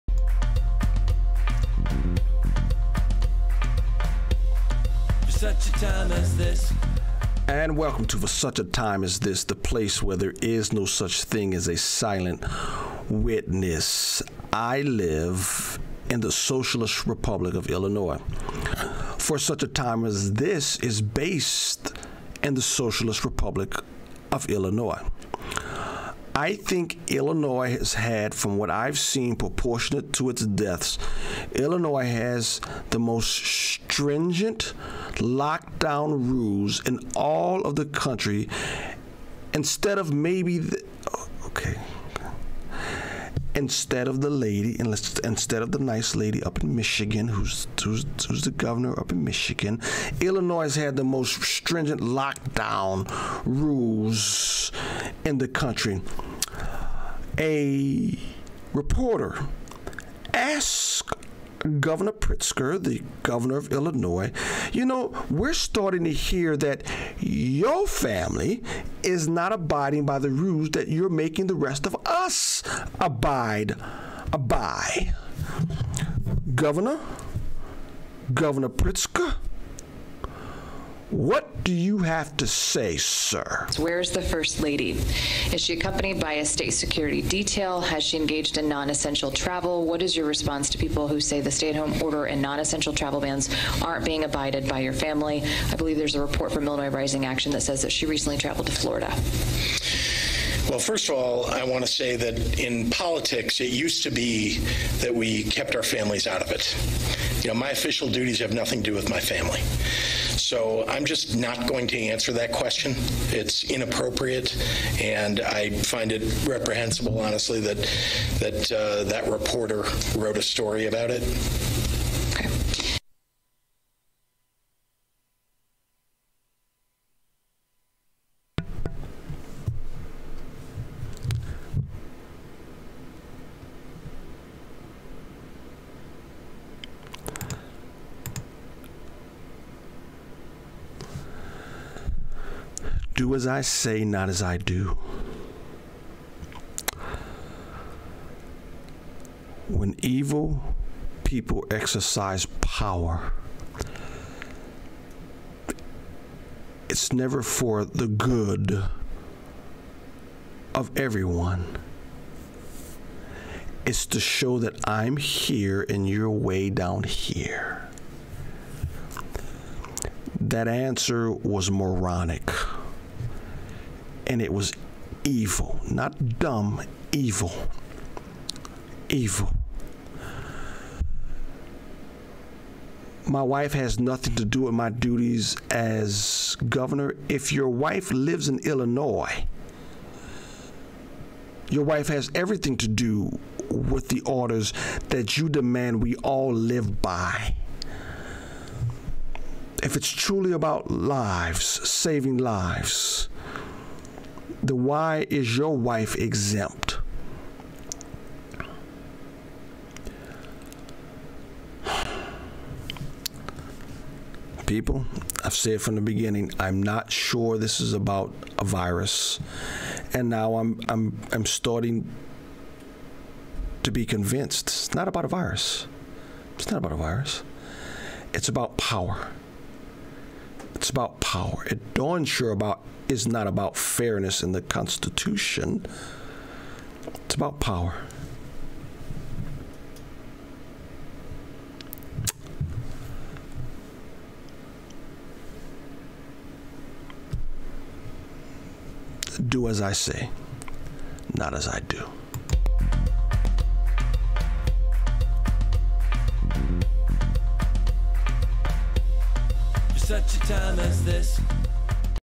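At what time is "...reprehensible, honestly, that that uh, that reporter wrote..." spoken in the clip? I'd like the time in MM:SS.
01:56.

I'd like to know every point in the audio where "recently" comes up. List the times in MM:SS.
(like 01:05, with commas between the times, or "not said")
01:38.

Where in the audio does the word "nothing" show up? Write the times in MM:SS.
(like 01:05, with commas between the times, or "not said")
01:48, 03:03.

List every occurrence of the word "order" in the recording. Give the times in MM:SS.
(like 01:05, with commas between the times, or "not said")
01:32, 03:14.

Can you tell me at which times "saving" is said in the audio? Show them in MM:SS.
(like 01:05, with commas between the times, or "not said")
03:21.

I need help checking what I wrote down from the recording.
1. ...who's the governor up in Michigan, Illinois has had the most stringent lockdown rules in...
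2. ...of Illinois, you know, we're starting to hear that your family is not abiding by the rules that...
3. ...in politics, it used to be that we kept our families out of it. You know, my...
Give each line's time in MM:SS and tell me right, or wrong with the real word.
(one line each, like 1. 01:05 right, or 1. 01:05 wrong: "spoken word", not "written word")
1. 00:48 right
2. 01:03 right
3. 01:42 right.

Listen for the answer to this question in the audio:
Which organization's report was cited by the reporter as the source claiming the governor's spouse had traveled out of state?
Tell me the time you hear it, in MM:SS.
01:36.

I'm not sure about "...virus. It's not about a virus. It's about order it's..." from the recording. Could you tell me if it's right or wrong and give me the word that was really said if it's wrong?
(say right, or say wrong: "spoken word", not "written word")
wrong: "power", not "order".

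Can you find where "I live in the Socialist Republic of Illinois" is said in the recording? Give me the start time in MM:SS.
00:14.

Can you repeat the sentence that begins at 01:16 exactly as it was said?
Governor, Governor Pritzker, what do you have to say, sir?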